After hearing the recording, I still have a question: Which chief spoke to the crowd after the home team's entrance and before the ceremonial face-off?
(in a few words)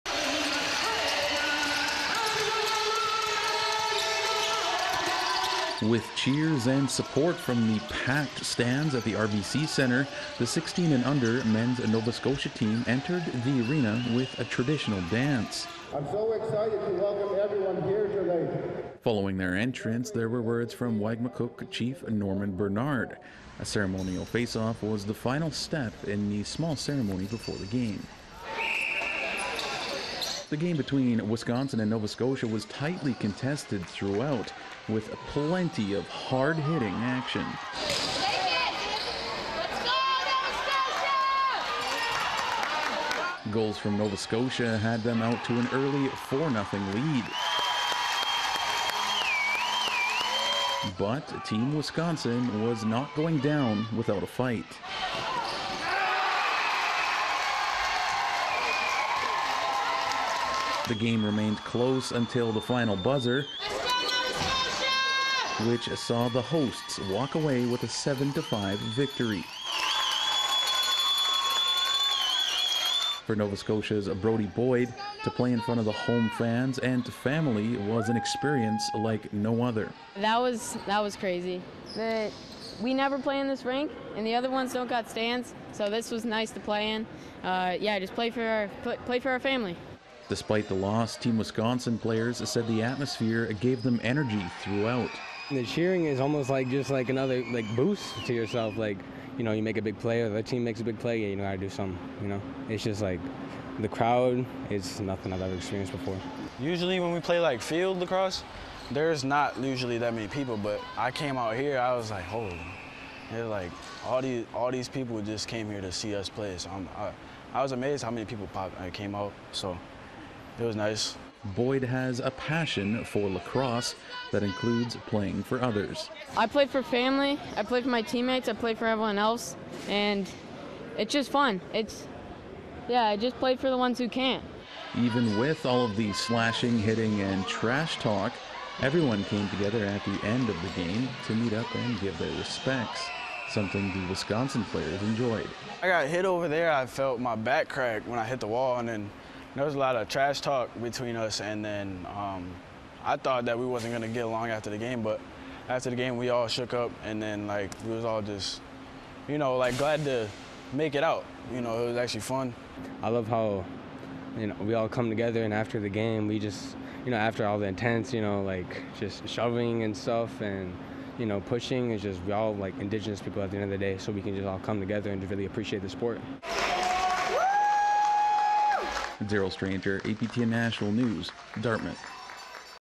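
Norman Bernard.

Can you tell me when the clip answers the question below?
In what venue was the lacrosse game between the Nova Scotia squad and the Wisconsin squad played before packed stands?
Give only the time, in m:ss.
0:09.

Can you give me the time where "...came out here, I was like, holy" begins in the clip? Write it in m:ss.
1:51.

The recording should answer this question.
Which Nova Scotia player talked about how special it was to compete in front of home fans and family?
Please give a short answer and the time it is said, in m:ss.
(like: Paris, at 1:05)
Brody Boyd, at 1:14.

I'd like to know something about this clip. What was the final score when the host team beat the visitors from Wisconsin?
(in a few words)
7-5.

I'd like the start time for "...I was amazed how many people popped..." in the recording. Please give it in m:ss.
1:57.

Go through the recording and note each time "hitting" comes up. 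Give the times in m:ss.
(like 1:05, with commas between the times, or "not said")
0:36, 2:16.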